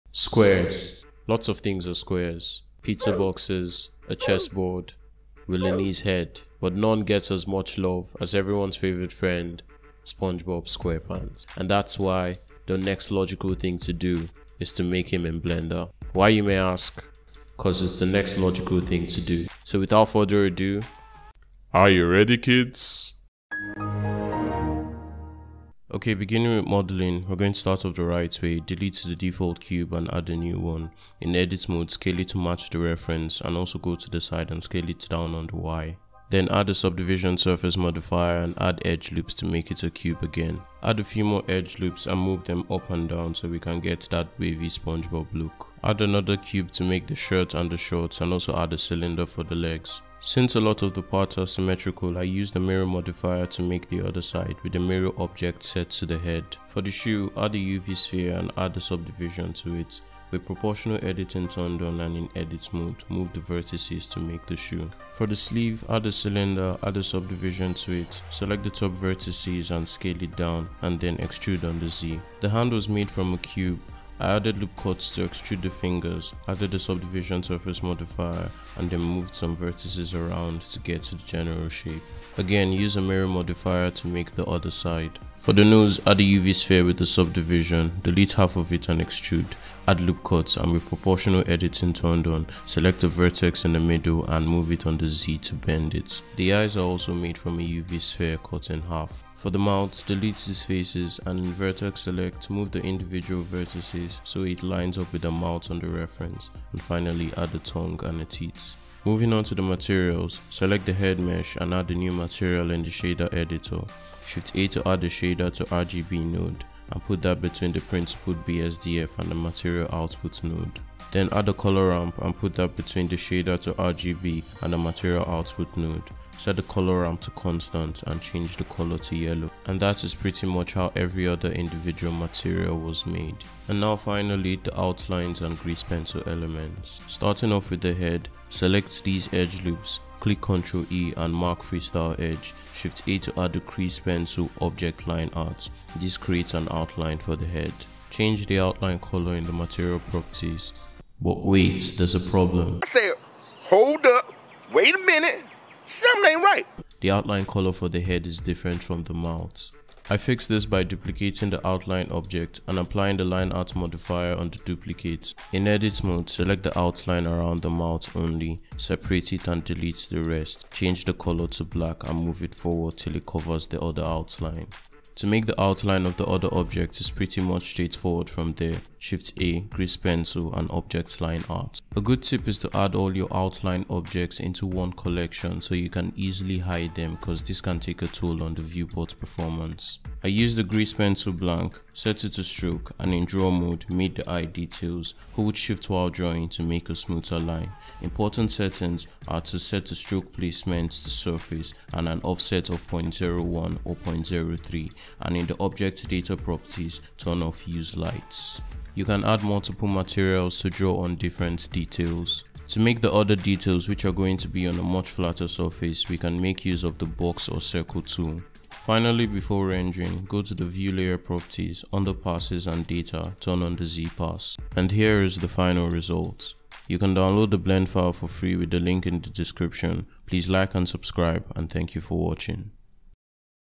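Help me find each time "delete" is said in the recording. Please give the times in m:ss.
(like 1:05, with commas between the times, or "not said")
0:28, 1:28, 1:40, 2:49.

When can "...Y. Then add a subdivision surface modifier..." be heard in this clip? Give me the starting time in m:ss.
0:35.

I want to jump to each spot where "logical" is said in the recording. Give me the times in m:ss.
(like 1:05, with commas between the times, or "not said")
0:13, 0:18.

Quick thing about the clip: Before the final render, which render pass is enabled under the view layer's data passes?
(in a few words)
Z pass.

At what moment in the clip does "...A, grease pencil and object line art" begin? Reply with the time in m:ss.
2:59.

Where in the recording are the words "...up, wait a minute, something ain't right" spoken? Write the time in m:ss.
2:34.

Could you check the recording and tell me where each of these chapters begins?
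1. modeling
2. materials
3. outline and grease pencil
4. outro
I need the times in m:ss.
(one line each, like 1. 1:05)
1. 0:26
2. 1:49
3. 2:14
4. 3:45.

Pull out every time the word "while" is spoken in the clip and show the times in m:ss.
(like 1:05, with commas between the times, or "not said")
3:15.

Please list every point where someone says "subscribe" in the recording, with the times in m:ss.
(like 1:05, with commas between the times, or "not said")
3:50.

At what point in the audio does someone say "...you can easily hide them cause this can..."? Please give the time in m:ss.
3:05.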